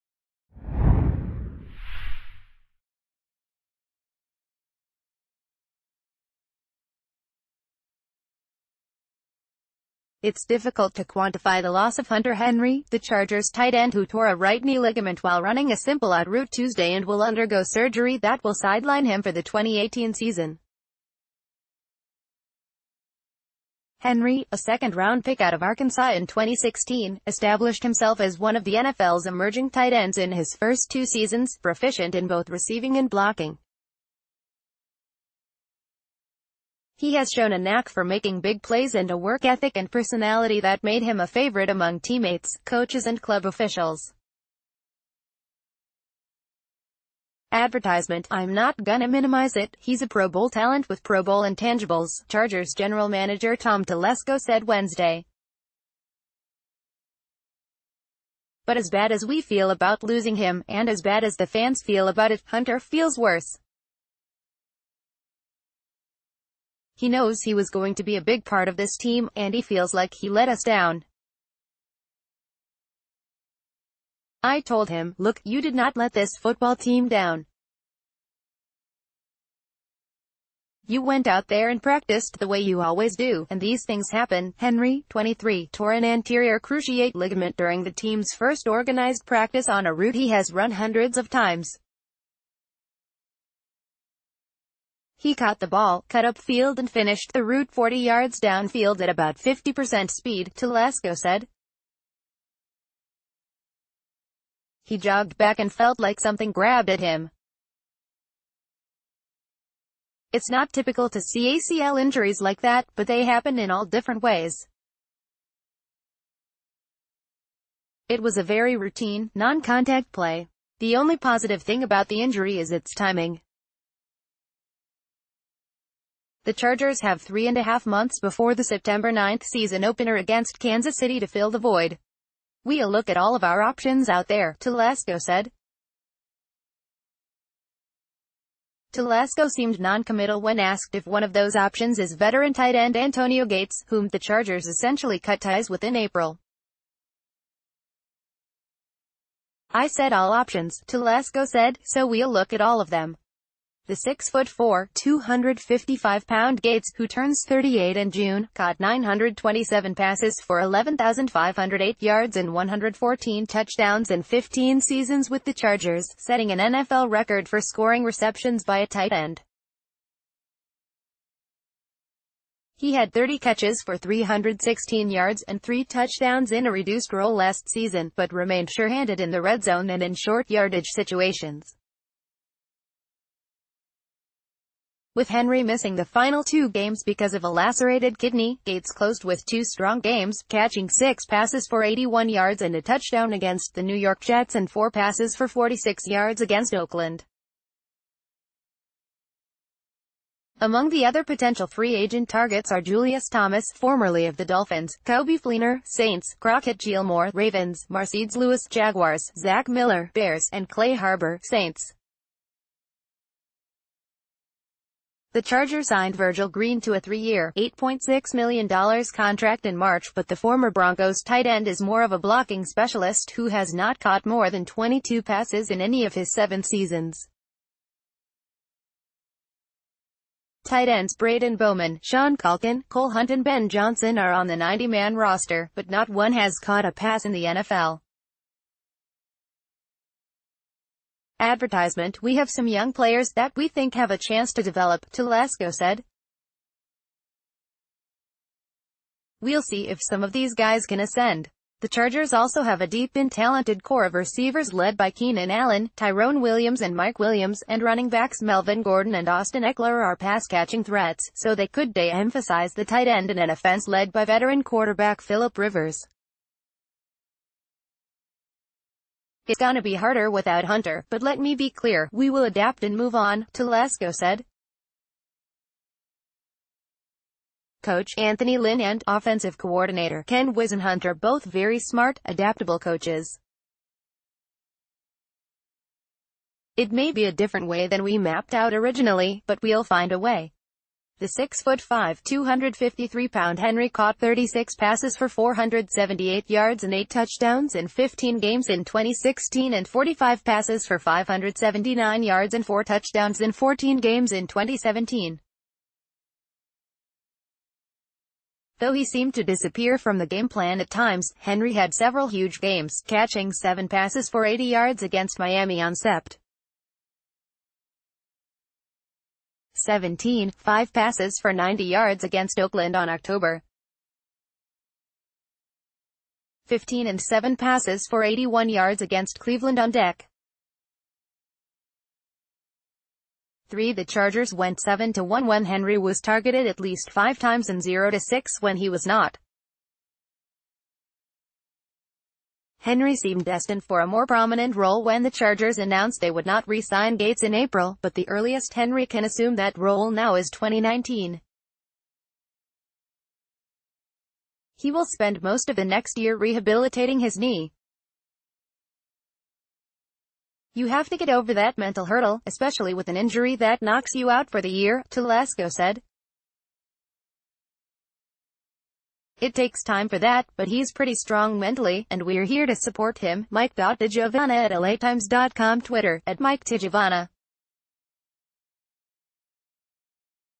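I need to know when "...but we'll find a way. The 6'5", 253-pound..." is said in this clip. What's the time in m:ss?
4:49.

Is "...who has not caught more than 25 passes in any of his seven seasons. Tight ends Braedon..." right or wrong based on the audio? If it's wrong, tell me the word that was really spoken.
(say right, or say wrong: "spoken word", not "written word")
wrong: "22", not "25".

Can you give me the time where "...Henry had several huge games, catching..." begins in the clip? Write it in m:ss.
5:11.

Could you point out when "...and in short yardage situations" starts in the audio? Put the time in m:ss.
2:59.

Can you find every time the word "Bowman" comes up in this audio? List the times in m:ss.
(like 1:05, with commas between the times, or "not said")
3:51.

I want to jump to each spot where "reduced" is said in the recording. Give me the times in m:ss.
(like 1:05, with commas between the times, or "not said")
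2:56.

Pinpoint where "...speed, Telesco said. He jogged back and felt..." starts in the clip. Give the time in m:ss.
1:40.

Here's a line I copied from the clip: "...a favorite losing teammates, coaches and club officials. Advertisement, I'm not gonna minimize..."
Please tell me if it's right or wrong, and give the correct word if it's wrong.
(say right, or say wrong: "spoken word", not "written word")
wrong: "among", not "losing".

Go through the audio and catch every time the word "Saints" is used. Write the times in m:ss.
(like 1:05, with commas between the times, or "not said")
3:25, 3:31.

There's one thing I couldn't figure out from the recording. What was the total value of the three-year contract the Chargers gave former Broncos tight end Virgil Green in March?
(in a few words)
$8.6 million.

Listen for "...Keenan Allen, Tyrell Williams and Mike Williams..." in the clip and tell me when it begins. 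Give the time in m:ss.
4:15.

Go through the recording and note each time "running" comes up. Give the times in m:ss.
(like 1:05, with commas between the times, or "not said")
0:15, 4:17.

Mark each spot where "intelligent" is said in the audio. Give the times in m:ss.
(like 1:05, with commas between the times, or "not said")
not said.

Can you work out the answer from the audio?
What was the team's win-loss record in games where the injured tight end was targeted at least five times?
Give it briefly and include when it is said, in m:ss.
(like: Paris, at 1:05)
7-1, at 5:34.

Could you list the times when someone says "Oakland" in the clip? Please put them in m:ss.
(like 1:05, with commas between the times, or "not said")
3:16, 5:22.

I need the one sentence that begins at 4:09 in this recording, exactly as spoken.
We'll see if some of these guys can ascend.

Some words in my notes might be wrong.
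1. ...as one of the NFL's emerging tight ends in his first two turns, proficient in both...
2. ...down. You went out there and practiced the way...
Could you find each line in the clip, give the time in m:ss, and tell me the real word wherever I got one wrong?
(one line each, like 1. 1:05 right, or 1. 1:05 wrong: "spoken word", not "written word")
1. 0:28 wrong: "seasons", not "turns"
2. 1:17 right.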